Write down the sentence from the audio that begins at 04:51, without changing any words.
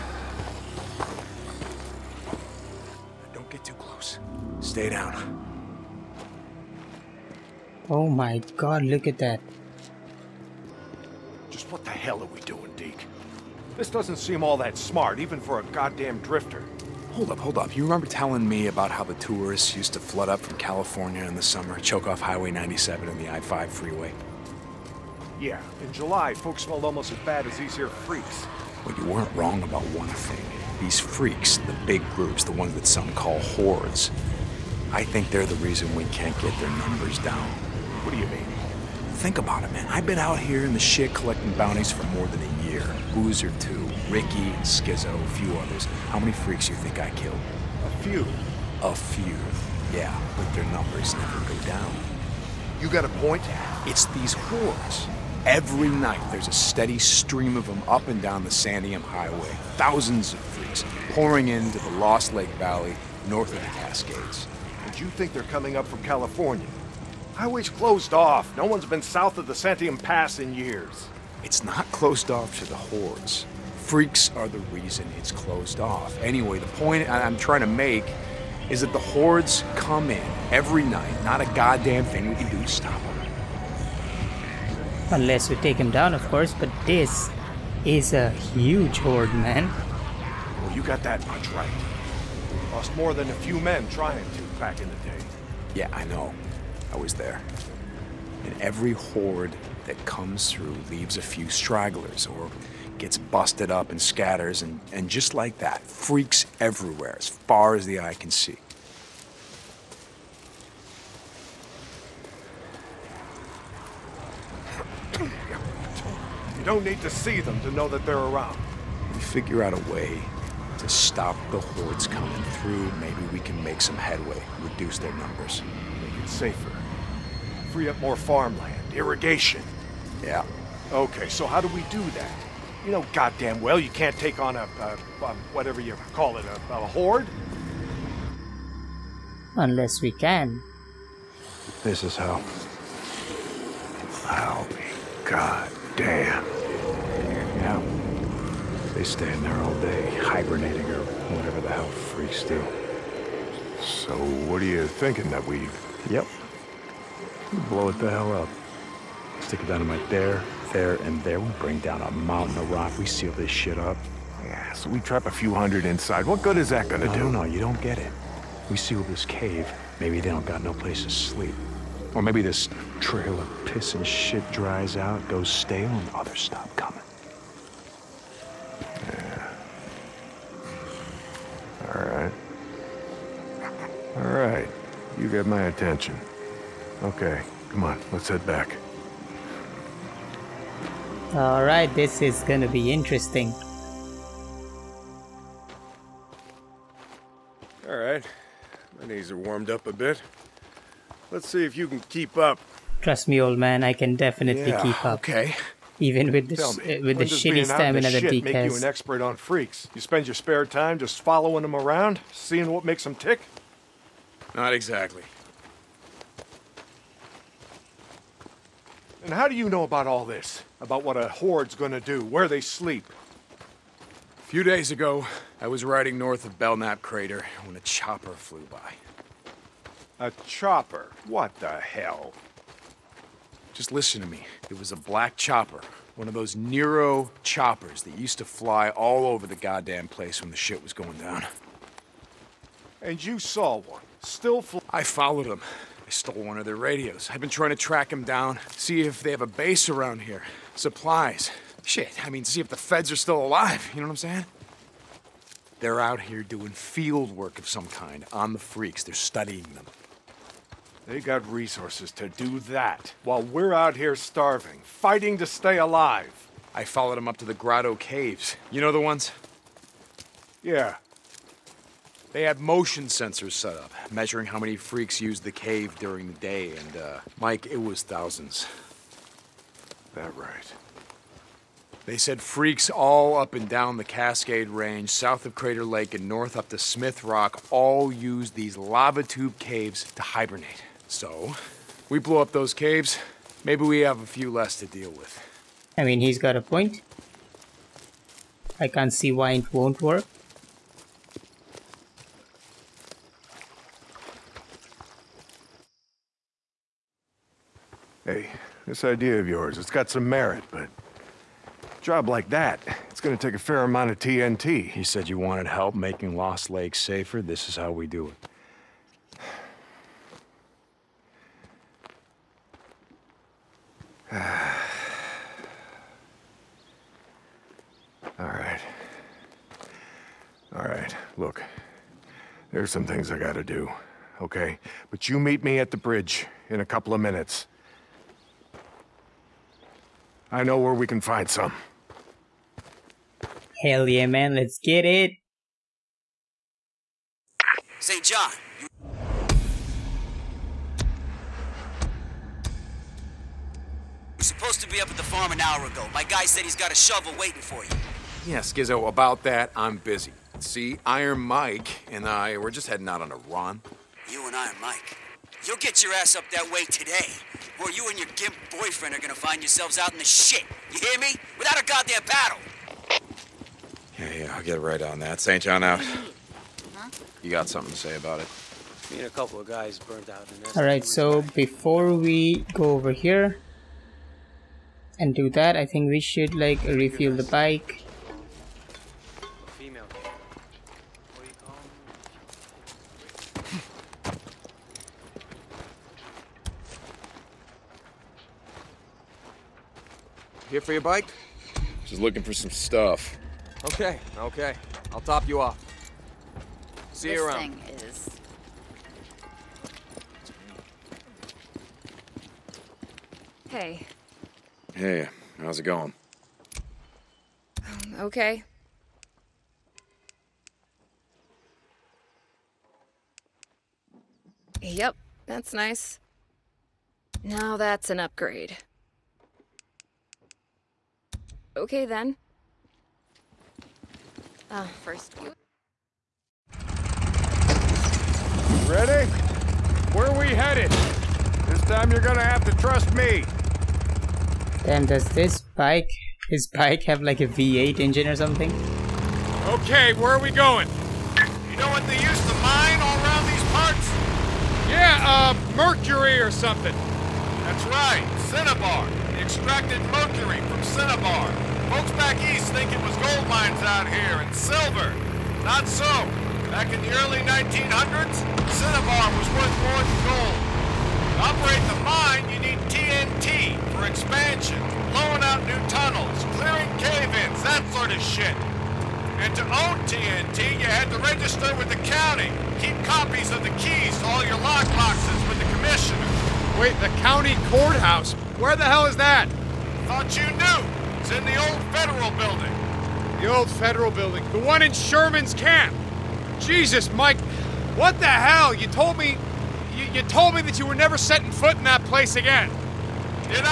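So, we blow up those caves, maybe we have a few less to deal with.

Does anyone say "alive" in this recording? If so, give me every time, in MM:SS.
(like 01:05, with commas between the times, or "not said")
04:13, 04:25.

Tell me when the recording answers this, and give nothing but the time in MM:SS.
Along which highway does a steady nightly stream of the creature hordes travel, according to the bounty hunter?
00:58.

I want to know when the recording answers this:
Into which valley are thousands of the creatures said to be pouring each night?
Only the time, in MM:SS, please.
01:01.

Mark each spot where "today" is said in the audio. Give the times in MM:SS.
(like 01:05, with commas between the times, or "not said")
06:06.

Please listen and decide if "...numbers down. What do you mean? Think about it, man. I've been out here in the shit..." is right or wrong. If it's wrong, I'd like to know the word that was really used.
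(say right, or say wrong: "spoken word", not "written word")
right.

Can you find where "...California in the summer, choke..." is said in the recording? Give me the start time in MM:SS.
00:20.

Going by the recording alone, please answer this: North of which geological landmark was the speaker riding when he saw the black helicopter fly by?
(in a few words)
Belknap Crater.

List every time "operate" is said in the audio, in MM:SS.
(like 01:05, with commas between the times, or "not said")
07:51.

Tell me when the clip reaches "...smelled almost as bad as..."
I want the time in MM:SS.
00:26.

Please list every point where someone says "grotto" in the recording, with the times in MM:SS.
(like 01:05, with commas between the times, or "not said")
04:27.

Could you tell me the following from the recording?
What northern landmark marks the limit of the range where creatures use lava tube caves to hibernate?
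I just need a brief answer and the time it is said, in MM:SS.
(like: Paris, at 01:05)
Smith Rock, at 04:46.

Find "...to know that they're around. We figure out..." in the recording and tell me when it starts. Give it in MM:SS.
01:57.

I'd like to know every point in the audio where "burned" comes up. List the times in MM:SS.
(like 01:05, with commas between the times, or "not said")
06:19.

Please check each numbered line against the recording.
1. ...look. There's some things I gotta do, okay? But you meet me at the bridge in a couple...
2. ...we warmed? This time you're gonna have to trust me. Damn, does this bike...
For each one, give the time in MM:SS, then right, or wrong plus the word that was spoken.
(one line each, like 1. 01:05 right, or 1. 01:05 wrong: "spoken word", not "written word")
1. 05:31 right
2. 07:20 wrong: "headed", not "warmed".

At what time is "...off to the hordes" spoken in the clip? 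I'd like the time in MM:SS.
01:12.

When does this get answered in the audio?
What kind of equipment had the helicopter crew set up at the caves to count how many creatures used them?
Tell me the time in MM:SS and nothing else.
04:32.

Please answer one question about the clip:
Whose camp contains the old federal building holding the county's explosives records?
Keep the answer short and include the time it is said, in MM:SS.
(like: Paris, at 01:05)
Sherman's camp, at 08:14.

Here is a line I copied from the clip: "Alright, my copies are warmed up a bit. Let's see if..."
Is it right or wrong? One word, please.
wrong.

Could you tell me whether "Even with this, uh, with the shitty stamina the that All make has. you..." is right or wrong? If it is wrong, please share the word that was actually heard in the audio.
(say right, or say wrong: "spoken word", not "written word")
wrong: "Deke", not "All".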